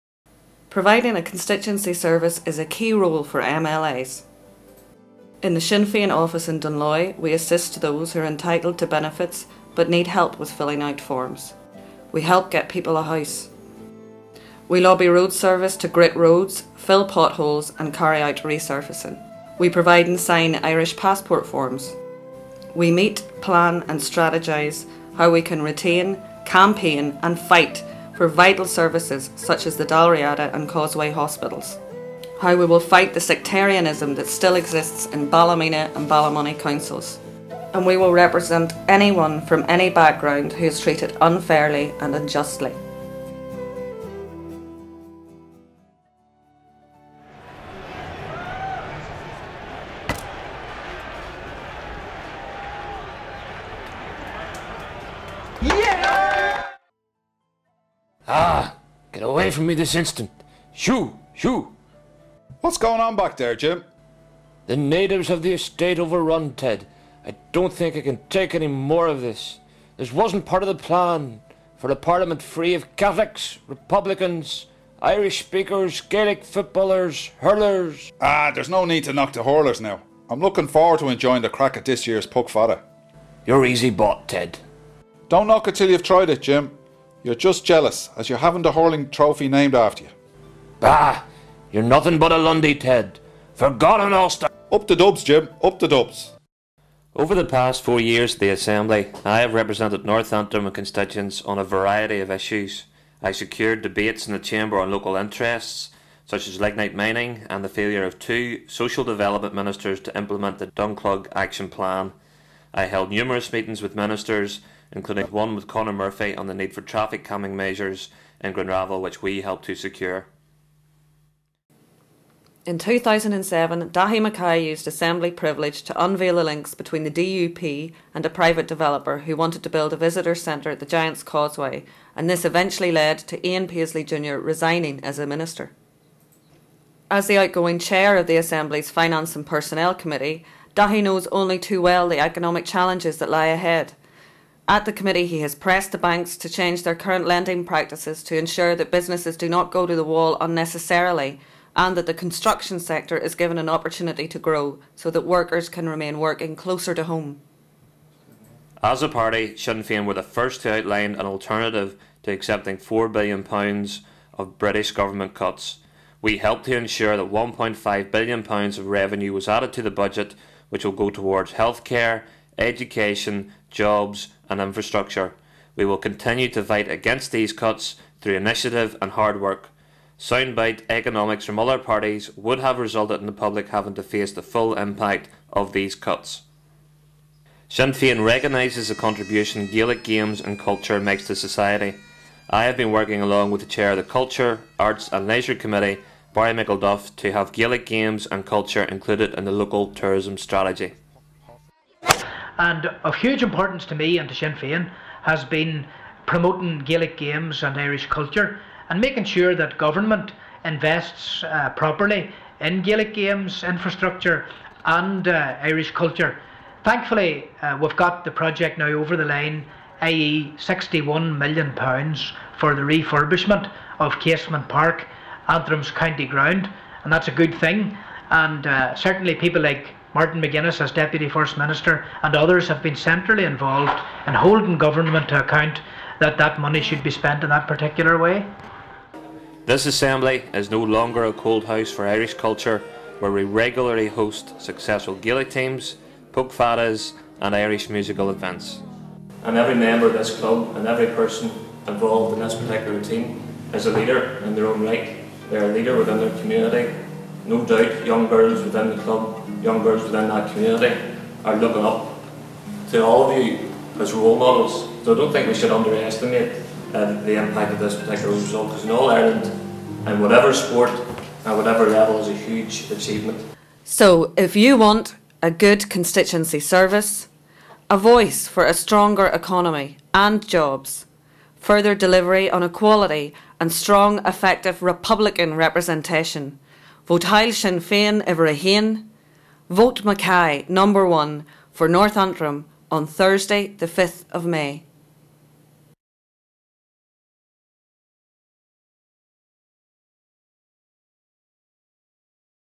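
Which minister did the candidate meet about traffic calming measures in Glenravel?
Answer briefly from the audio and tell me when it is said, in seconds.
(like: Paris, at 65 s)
Conor Murphy, at 115 s.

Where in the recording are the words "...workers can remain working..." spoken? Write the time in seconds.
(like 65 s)
155 s.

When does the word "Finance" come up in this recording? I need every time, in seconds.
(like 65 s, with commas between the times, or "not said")
138 s.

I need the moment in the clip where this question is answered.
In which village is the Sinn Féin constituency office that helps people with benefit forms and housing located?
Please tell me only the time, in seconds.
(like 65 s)
6 s.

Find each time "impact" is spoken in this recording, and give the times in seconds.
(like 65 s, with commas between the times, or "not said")
184 s, 267 s.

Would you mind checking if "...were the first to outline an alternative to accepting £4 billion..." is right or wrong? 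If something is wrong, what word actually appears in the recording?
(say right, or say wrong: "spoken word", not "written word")
right.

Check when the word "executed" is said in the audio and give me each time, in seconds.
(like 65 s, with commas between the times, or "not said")
not said.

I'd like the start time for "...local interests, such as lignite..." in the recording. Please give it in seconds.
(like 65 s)
104 s.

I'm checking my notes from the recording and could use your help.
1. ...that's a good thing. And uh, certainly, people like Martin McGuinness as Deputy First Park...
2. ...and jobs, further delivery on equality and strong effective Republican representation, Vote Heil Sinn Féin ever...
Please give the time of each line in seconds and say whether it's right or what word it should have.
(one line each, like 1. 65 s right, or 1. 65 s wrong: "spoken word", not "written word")
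1. 227 s wrong: "Minister", not "Park"
2. 280 s right.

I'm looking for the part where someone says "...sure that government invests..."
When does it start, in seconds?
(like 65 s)
209 s.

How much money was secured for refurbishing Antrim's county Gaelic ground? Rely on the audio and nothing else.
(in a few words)
£61 million.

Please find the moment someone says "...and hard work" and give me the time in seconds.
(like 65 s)
179 s.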